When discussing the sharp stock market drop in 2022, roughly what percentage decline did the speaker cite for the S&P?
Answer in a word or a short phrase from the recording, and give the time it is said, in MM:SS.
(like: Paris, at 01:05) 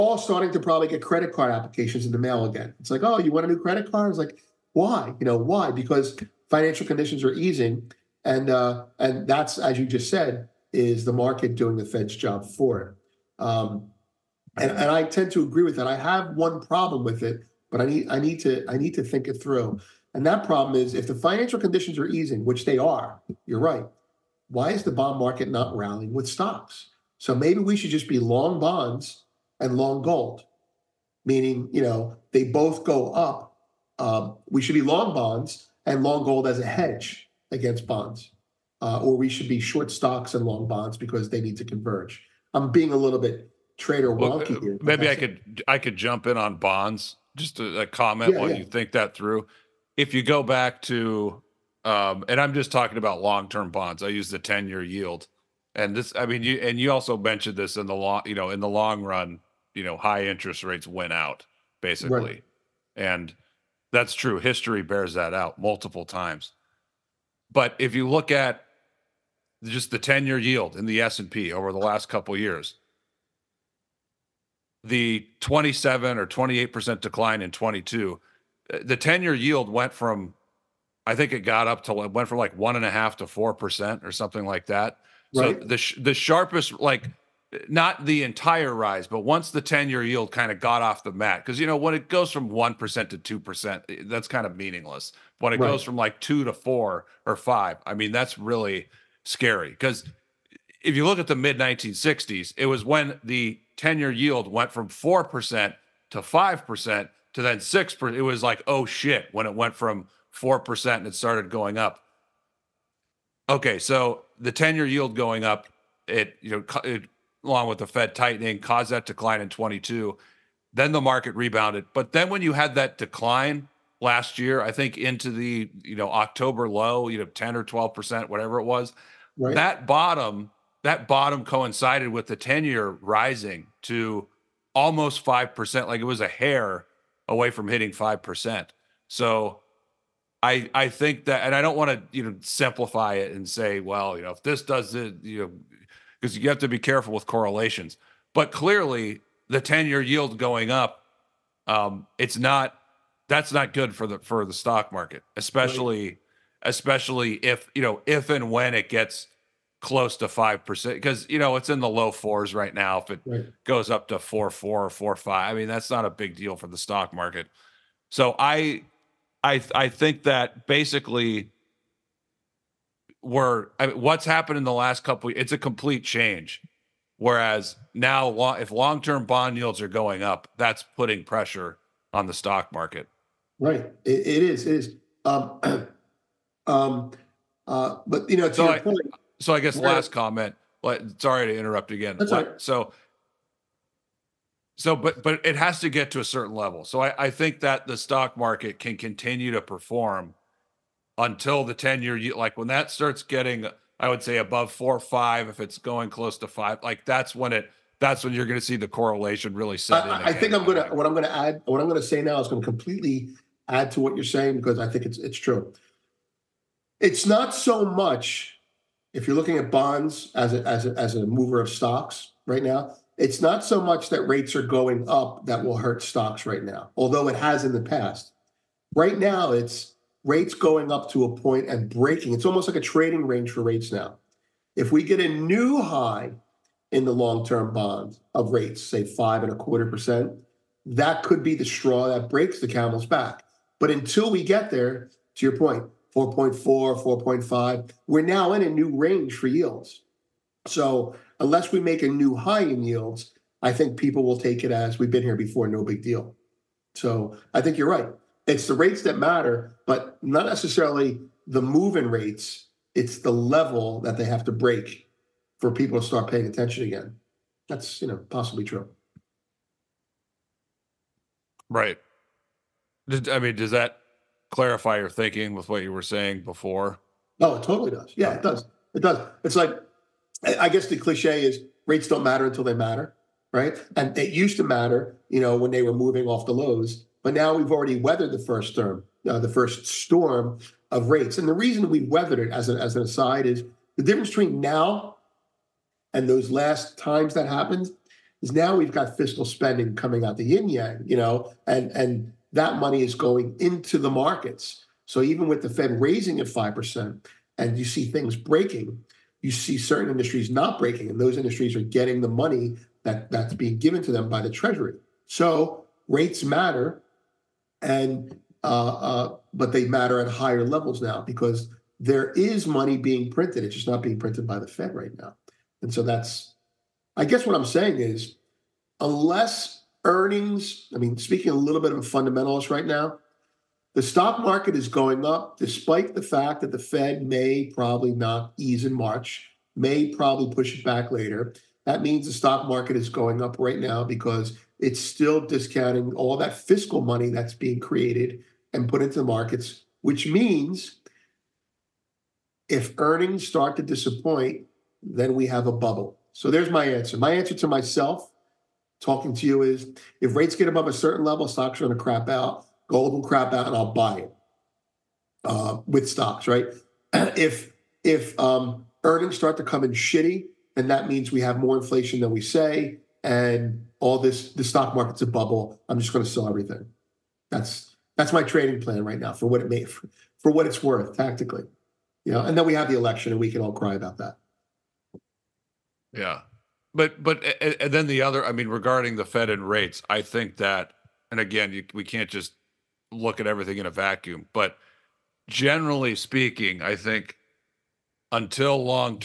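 27 or 28%, at 01:15.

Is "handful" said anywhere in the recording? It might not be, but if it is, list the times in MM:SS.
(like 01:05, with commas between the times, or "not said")
not said.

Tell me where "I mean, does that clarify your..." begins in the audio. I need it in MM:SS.
04:33.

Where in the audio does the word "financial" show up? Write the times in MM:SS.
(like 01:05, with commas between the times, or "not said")
00:06, 00:21.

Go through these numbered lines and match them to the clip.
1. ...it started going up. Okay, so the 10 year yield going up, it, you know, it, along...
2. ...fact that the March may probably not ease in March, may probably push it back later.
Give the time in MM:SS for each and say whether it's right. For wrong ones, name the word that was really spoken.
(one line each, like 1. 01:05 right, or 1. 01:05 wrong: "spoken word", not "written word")
1. 01:51 right
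2. 05:36 wrong: "Fed", not "March".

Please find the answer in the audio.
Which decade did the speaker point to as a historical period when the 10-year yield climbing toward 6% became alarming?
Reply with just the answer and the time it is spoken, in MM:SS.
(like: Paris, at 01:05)
mid 1960s, at 01:41.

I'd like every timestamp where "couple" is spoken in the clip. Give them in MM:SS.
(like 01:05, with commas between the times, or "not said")
01:12, 02:55.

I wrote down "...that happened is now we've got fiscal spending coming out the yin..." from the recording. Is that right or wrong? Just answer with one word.
right.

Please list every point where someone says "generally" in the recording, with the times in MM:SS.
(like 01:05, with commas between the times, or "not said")
06:35.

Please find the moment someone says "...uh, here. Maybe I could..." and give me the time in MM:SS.
00:44.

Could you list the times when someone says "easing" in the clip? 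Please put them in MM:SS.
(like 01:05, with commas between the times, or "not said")
00:07, 00:22.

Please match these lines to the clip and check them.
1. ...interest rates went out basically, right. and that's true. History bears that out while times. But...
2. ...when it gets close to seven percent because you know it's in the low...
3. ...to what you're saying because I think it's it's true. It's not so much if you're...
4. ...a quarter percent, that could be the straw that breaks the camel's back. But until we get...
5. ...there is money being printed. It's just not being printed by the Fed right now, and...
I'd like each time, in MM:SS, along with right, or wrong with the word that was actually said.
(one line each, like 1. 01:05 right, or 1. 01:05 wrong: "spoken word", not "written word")
1. 01:00 wrong: "multiple", not "while"
2. 02:38 wrong: "five", not "seven"
3. 03:33 right
4. 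03:59 right
5. 05:21 right.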